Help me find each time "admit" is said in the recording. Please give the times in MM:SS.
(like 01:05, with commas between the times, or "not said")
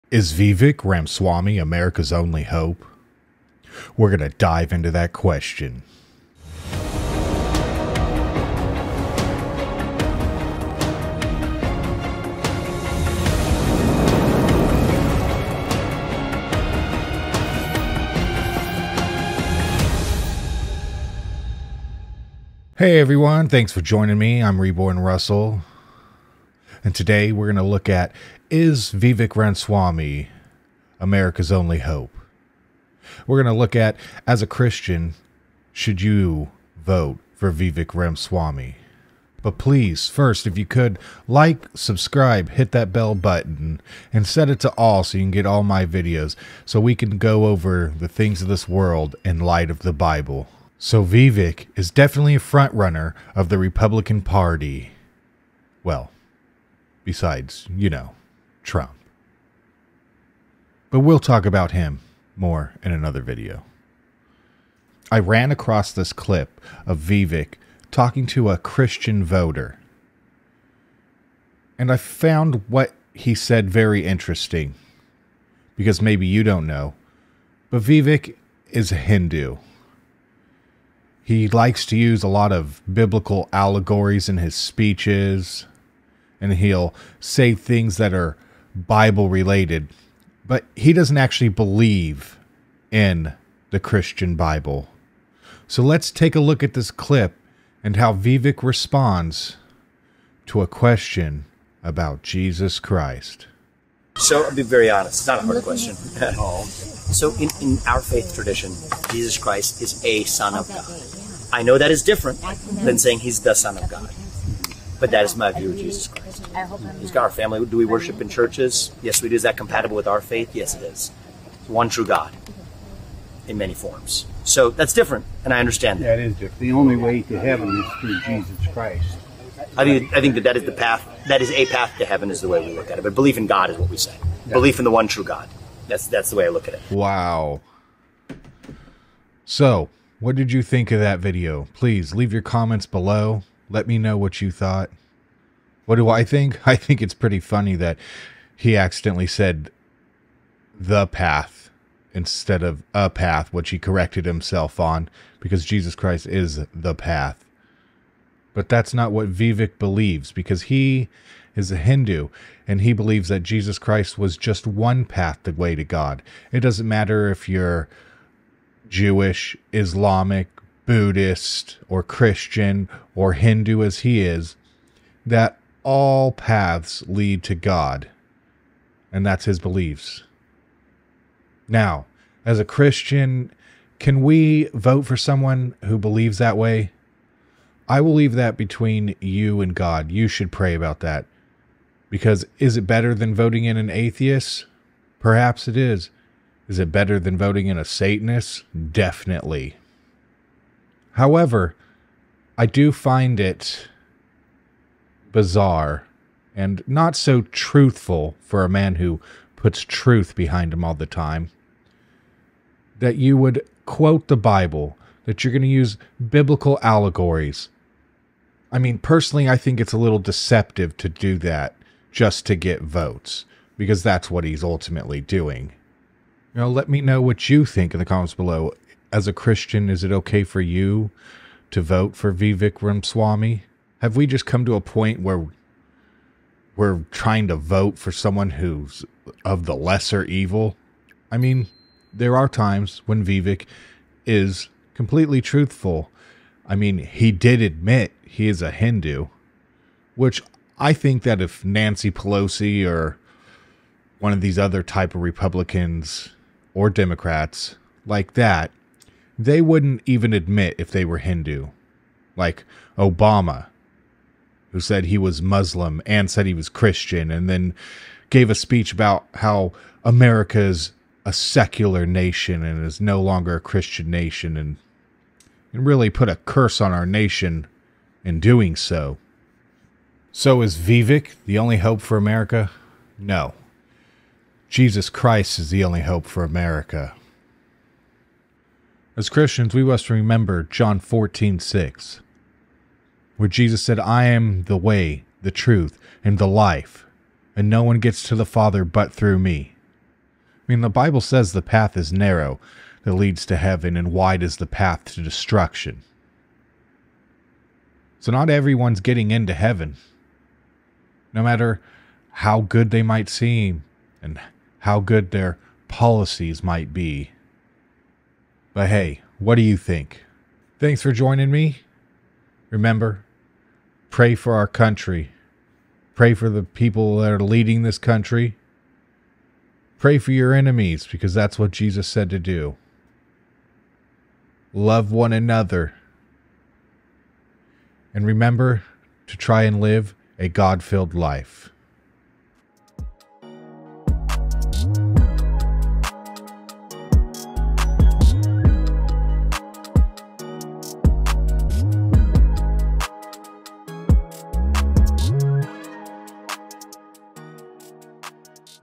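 04:07, 04:20.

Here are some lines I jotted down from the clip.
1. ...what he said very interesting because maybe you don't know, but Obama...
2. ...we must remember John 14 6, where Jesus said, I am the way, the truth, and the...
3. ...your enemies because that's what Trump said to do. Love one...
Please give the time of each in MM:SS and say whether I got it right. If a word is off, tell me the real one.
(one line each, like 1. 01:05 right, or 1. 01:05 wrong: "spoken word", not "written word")
1. 01:12 wrong: "Vivek", not "Obama"
2. 04:49 right
3. 05:30 wrong: "Jesus", not "Trump".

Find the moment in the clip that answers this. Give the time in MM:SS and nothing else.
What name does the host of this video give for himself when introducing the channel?
00:24.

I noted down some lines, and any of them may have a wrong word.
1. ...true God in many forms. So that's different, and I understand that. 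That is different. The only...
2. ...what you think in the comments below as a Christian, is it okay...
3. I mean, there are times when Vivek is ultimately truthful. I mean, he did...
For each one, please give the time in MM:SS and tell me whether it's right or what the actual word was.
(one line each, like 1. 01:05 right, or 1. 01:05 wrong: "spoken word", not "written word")
1. 02:01 right
2. 03:47 right
3. 04:01 wrong: "completely", not "ultimately".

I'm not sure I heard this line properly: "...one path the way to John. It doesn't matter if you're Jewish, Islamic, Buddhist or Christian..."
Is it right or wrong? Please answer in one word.
wrong.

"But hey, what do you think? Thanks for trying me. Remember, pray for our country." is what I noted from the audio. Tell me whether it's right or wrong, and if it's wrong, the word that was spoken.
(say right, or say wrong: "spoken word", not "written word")
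wrong: "joining", not "trying".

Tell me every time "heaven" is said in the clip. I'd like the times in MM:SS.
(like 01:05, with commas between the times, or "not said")
02:07, 02:12, 05:03, 05:09.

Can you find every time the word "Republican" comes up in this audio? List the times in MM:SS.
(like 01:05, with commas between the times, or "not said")
00:53, 04:15.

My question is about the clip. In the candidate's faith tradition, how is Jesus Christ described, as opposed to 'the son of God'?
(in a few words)
a son of God.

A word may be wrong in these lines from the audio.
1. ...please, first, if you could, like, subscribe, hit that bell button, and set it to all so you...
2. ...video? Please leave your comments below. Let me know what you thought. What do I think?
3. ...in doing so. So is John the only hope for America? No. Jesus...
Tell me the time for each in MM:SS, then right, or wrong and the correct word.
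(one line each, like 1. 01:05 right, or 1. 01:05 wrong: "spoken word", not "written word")
1. 00:39 right
2. 02:21 right
3. 04:38 wrong: "Vivek", not "John".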